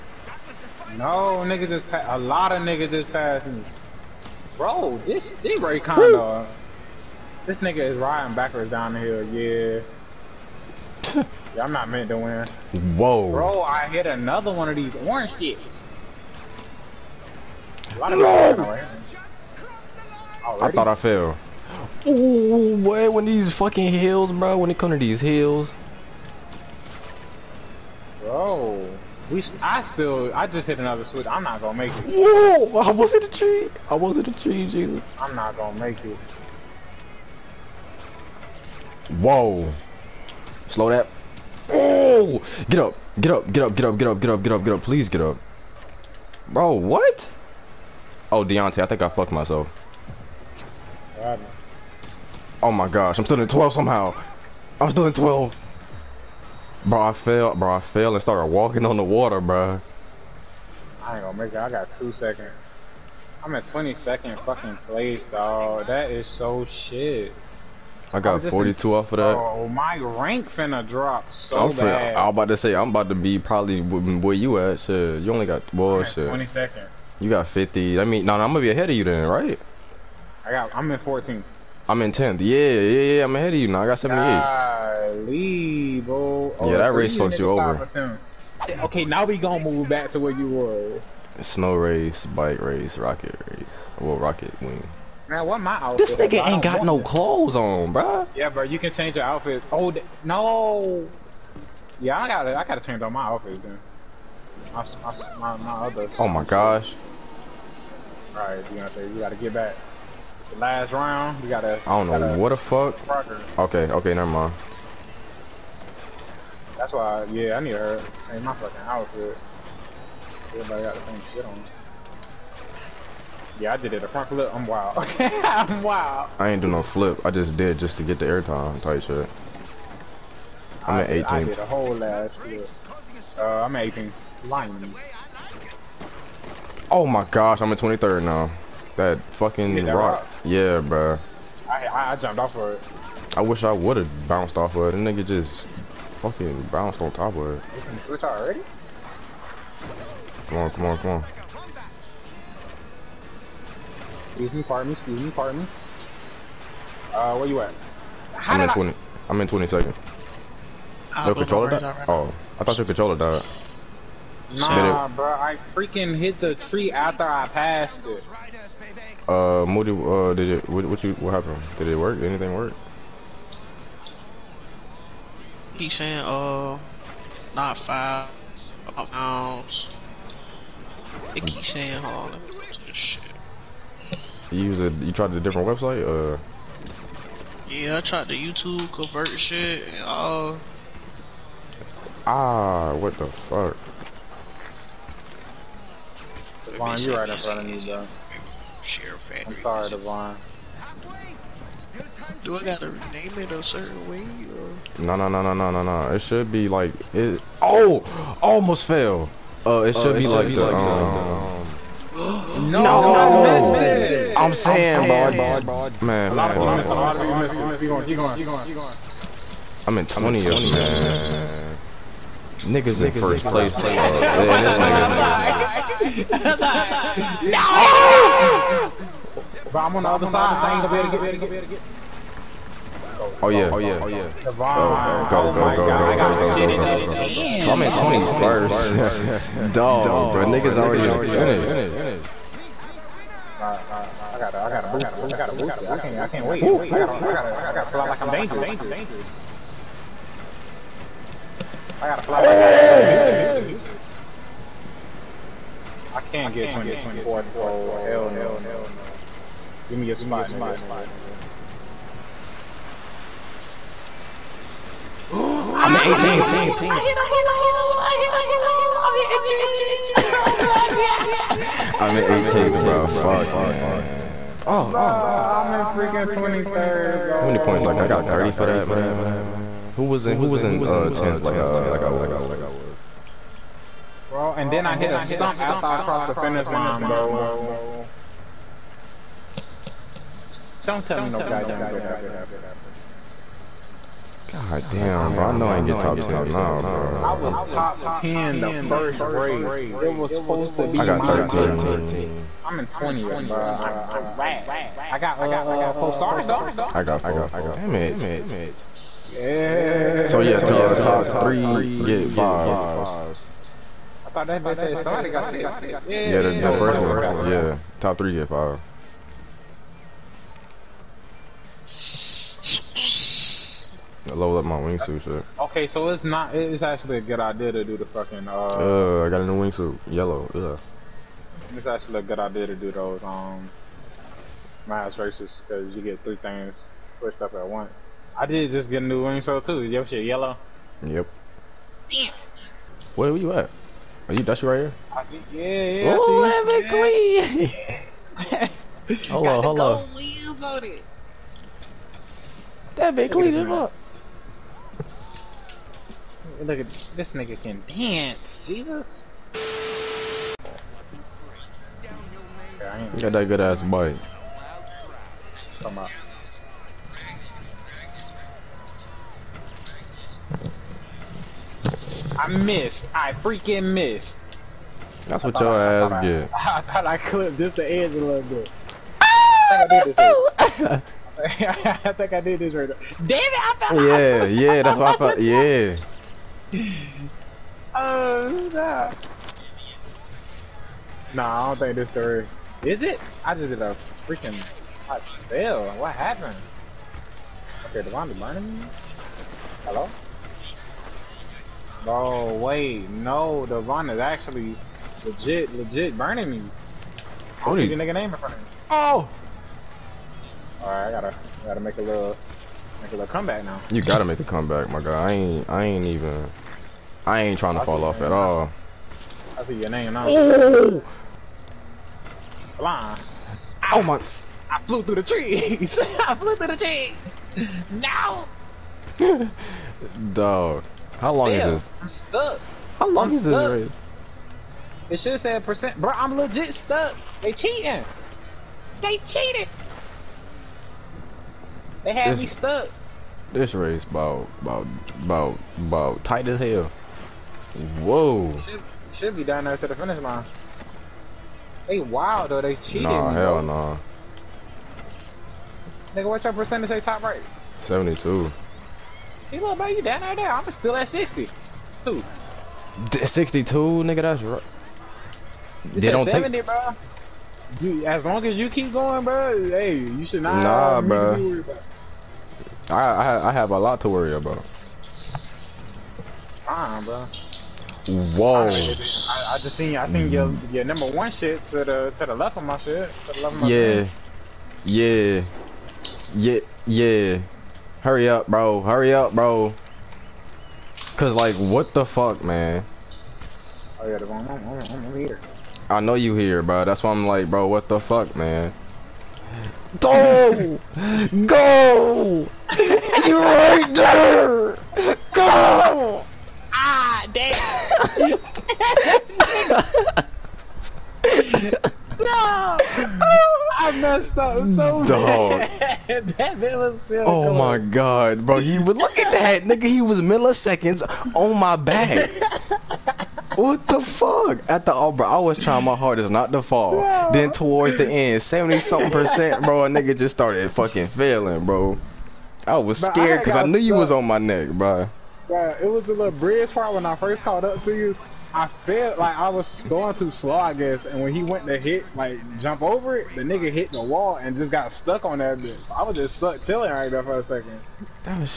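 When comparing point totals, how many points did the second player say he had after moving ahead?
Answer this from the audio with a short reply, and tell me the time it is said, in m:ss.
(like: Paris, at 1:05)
78, at 1:23.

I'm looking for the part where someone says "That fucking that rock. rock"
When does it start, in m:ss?
2:18.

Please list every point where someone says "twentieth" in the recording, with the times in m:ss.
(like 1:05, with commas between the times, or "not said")
3:40.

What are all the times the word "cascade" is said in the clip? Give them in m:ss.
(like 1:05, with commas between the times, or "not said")
not said.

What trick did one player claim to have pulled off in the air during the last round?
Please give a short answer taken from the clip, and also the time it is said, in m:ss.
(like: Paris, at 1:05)
A front flip, at 2:04.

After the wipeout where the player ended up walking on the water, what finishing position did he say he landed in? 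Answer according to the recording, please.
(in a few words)
22nd.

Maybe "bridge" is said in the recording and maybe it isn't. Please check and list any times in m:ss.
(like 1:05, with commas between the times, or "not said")
8:56.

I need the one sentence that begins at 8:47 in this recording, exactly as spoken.
Then towards the end, seventy something percent, bro, a nigga just started fucking failing, bro.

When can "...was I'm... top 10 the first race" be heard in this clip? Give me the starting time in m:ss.
4:57.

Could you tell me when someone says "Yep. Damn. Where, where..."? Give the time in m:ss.
5:41.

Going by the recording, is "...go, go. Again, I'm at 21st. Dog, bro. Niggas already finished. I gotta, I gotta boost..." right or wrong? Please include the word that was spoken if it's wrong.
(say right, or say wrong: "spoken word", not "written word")
right.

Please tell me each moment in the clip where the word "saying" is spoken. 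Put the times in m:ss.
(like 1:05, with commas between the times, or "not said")
2:55, 3:01, 3:34.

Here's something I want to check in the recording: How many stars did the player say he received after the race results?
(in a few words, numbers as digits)
4.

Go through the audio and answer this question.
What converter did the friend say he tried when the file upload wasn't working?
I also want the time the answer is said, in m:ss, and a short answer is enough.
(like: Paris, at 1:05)
YouTube convert, at 3:08.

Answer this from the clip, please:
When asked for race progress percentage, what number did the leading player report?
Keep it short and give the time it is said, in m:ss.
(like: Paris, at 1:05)
72, at 7:37.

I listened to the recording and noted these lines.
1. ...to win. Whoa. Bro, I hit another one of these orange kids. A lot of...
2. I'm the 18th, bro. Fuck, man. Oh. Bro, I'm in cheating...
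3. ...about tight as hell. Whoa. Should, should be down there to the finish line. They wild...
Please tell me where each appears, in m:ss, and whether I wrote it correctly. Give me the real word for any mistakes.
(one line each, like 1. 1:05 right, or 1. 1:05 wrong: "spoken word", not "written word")
1. 0:12 right
2. 4:31 wrong: "freaking", not "cheating"
3. 7:25 right.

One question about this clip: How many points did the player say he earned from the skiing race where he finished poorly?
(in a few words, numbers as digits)
42.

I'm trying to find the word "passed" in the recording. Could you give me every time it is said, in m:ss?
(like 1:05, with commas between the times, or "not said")
0:03, 2:47.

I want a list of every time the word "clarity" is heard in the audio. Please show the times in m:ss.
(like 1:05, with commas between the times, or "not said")
not said.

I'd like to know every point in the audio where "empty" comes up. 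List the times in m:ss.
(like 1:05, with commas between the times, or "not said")
not said.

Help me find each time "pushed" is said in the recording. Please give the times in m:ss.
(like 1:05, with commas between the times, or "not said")
5:37.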